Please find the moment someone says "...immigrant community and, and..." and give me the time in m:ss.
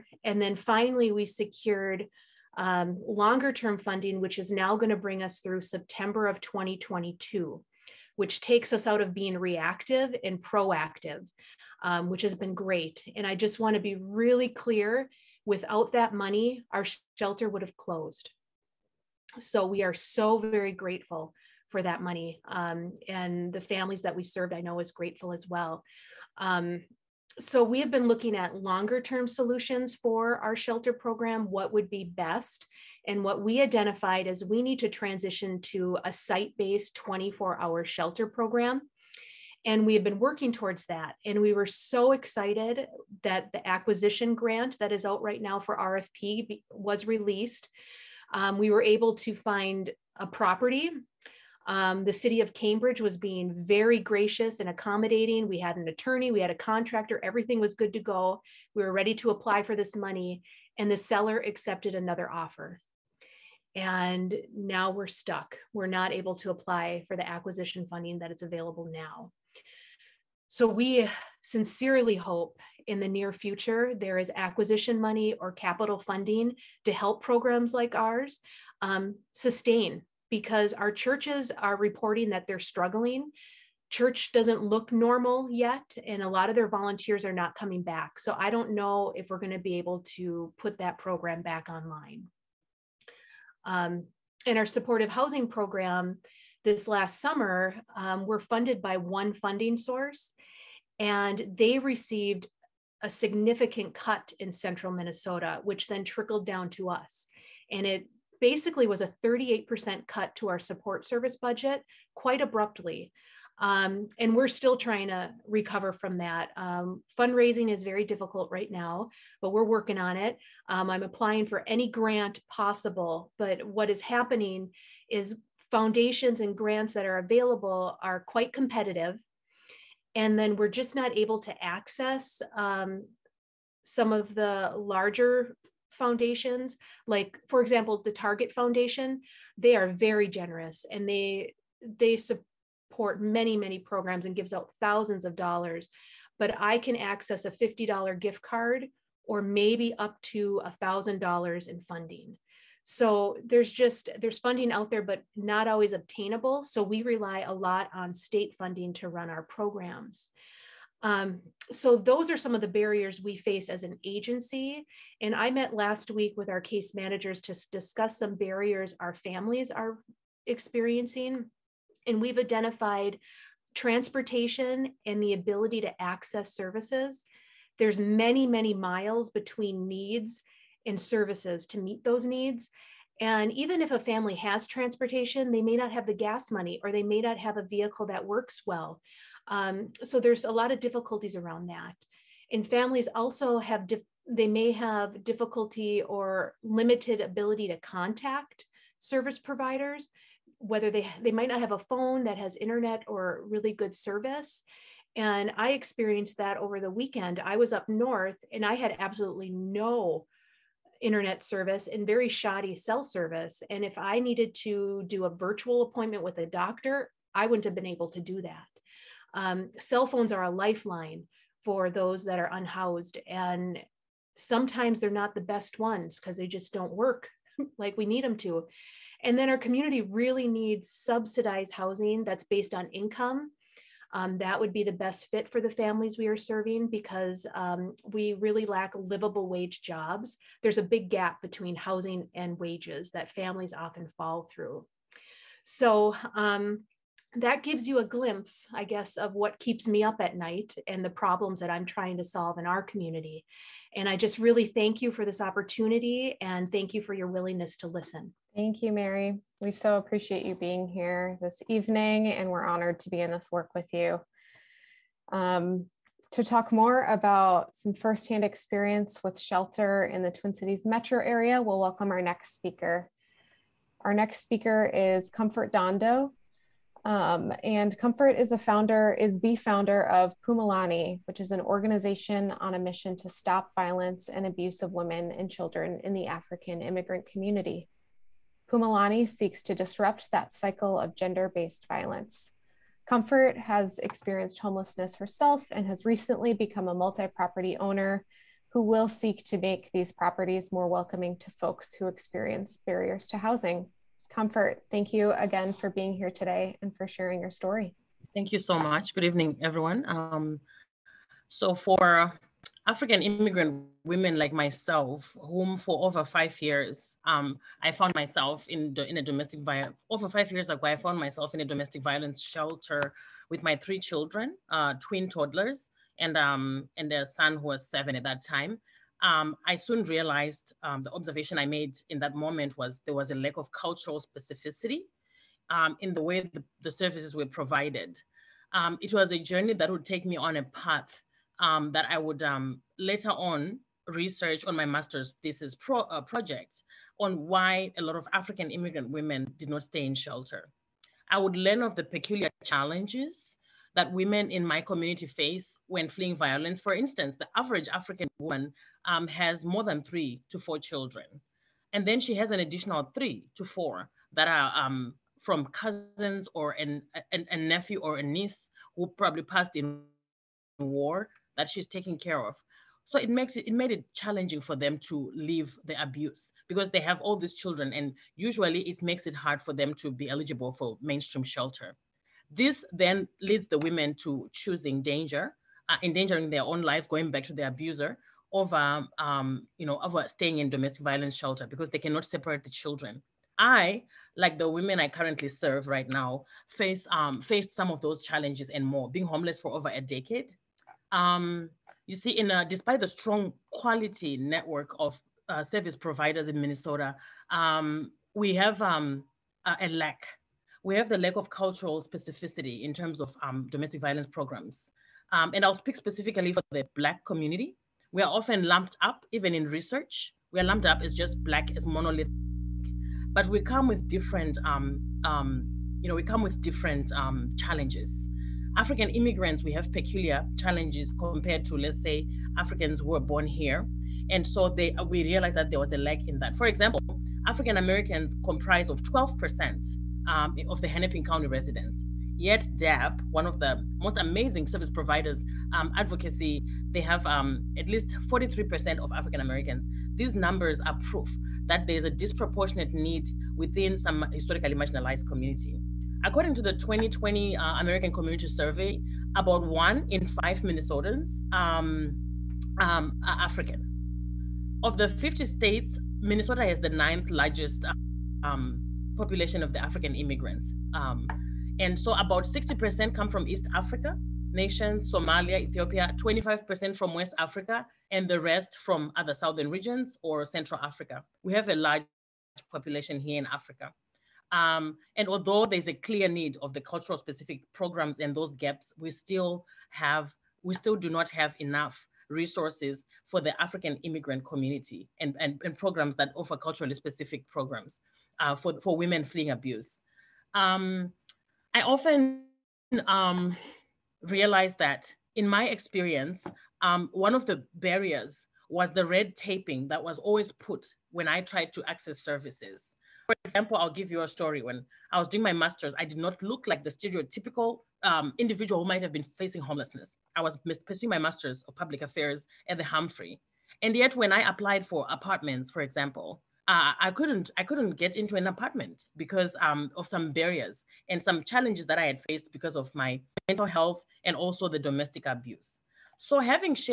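8:14.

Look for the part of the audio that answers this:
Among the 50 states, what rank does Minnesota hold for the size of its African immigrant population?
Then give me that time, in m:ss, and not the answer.
7:46.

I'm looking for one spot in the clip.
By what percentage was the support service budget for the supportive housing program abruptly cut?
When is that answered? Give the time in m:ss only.
1:49.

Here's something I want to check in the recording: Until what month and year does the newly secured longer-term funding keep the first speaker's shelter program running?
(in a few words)
September 2022.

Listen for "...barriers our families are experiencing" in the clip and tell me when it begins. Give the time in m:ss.
2:48.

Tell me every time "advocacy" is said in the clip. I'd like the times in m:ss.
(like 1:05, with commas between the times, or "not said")
7:25.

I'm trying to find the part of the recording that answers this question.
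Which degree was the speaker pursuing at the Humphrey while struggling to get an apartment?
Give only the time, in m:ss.
8:41.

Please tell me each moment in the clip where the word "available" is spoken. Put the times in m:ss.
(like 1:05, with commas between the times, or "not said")
1:08, 2:07.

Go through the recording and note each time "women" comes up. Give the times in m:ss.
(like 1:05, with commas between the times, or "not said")
4:44, 5:14, 5:49, 5:54, 6:23, 6:34, 8:18.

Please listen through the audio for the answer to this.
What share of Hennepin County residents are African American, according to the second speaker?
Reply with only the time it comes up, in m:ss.
7:19.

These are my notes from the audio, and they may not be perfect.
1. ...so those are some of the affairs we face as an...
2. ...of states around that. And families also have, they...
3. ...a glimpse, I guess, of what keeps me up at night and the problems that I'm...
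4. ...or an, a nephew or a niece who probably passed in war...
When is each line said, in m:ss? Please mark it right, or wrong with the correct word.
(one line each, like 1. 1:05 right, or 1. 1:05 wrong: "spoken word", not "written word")
1. 2:41 wrong: "barriers", not "affairs"
2. 3:10 wrong: "difficulties", not "states"
3. 4:07 right
4. 6:06 right.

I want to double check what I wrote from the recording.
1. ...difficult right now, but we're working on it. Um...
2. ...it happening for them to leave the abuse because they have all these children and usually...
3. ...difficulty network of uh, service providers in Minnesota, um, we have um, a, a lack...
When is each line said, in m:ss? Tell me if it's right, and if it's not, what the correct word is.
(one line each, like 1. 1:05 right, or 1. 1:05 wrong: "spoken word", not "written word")
1. 1:58 right
2. 6:13 wrong: "challenging", not "happening"
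3. 6:43 wrong: "quality", not "difficulty".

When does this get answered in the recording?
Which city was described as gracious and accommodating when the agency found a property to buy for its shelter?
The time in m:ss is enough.
0:52.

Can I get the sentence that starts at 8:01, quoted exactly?
We have a large population here in Africa.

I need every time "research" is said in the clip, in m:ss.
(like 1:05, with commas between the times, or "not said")
5:44, 6:59.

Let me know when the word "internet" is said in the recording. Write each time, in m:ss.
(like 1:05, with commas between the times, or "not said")
3:22, 3:31.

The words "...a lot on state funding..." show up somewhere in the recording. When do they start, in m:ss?
2:37.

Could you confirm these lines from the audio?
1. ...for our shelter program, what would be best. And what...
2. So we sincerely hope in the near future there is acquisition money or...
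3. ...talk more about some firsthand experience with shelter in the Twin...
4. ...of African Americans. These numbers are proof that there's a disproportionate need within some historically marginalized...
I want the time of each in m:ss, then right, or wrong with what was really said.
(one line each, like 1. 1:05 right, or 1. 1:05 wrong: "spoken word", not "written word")
1. 0:29 right
2. 1:10 right
3. 4:26 right
4. 7:28 right.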